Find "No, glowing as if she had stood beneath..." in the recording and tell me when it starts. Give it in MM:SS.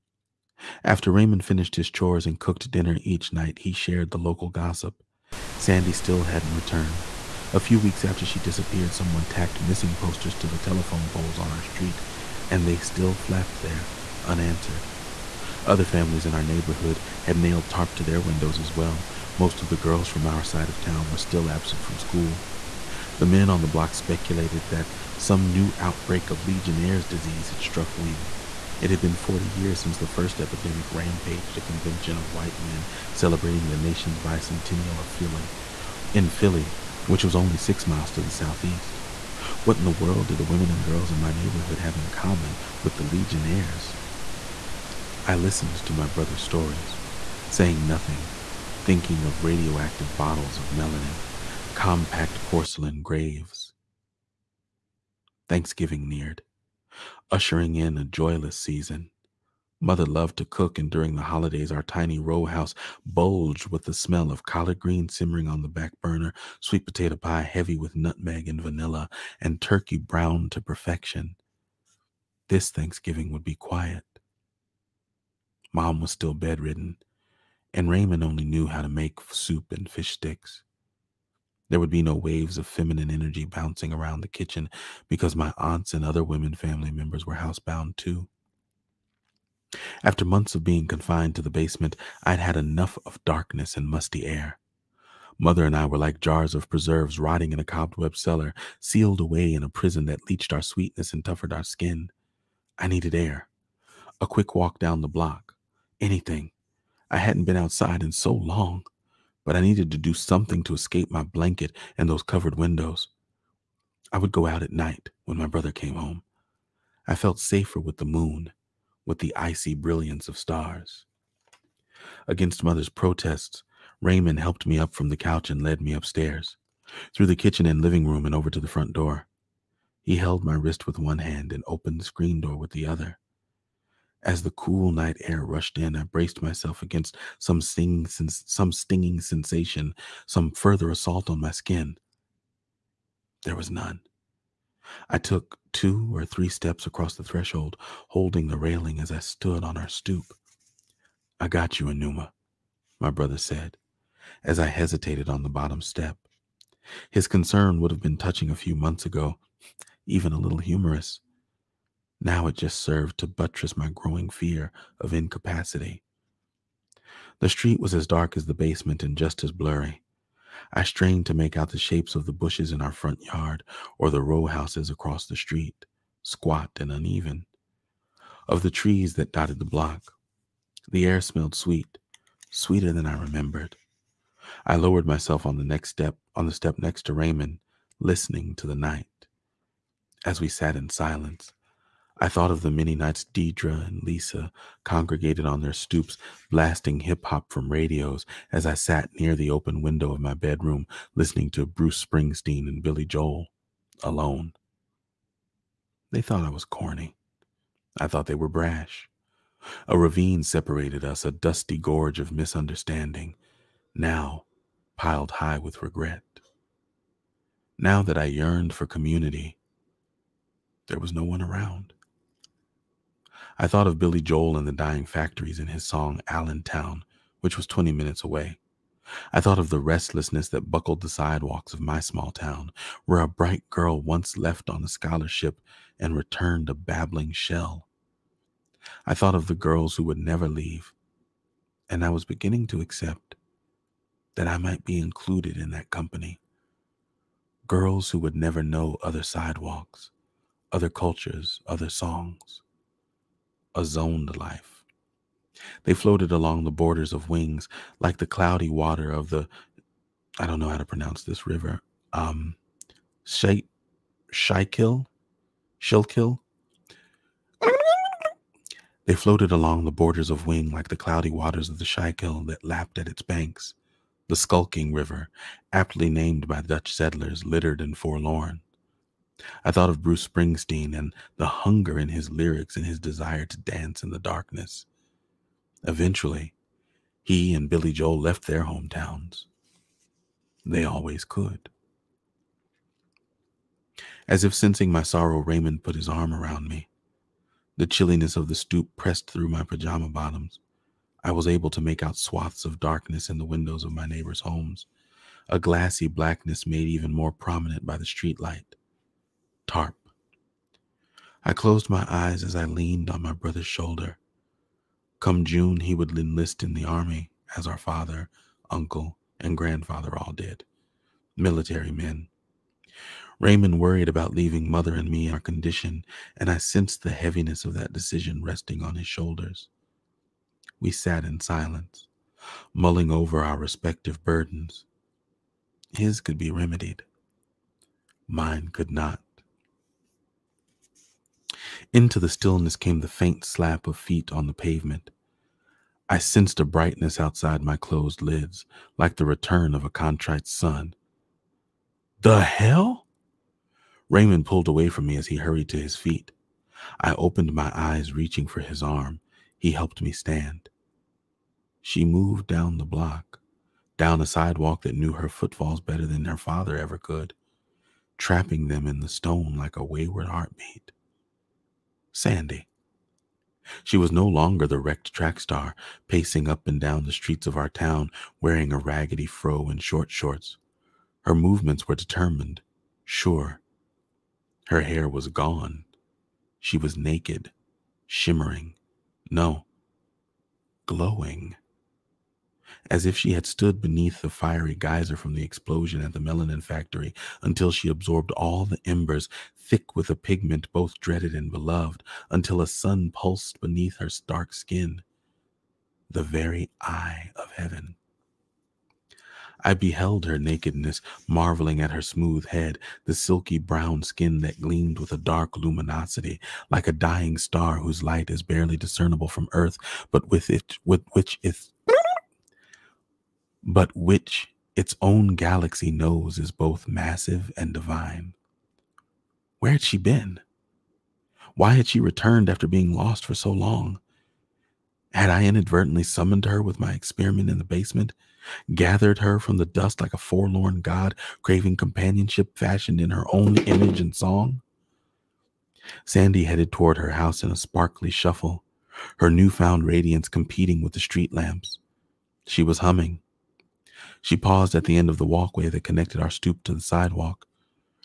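06:29.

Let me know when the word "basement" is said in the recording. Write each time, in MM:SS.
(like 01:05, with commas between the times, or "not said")
01:31, 02:48, 07:17.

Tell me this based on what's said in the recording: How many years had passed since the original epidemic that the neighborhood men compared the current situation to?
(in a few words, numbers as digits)
40.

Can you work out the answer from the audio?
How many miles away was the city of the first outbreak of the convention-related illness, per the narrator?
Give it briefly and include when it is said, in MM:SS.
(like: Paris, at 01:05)
6, at 00:37.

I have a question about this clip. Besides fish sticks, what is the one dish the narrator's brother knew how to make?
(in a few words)
Soup.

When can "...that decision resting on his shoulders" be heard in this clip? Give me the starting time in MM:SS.
05:27.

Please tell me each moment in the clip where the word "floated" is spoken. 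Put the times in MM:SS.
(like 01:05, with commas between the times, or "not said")
04:15, 04:29.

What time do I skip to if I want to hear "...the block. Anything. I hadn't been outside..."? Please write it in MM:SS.
01:45.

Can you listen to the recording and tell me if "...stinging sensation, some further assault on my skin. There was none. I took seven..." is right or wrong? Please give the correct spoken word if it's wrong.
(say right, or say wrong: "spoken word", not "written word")
wrong: "two", not "seven".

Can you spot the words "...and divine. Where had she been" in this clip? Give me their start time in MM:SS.
07:07.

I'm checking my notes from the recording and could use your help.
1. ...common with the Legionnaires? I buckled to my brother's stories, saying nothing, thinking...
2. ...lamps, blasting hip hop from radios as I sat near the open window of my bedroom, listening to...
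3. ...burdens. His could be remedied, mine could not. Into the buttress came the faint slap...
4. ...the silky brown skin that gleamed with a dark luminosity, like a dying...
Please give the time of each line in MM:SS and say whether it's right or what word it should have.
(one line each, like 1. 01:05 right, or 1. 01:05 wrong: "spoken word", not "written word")
1. 00:42 wrong: "listened", not "buckled"
2. 03:15 wrong: "stoops", not "lamps"
3. 05:34 wrong: "stillness", not "buttress"
4. 06:53 right.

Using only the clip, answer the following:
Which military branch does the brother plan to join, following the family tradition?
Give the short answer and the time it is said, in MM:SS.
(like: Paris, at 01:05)
The army, at 05:16.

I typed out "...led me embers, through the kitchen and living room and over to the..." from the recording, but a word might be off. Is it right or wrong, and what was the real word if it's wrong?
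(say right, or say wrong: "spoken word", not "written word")
wrong: "upstairs", not "embers".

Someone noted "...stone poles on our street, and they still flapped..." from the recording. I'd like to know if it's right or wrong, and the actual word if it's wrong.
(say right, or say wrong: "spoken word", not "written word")
wrong: "telephone", not "stone".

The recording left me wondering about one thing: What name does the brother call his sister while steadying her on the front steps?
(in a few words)
Enuma.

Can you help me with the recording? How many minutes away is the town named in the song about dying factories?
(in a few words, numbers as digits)
20.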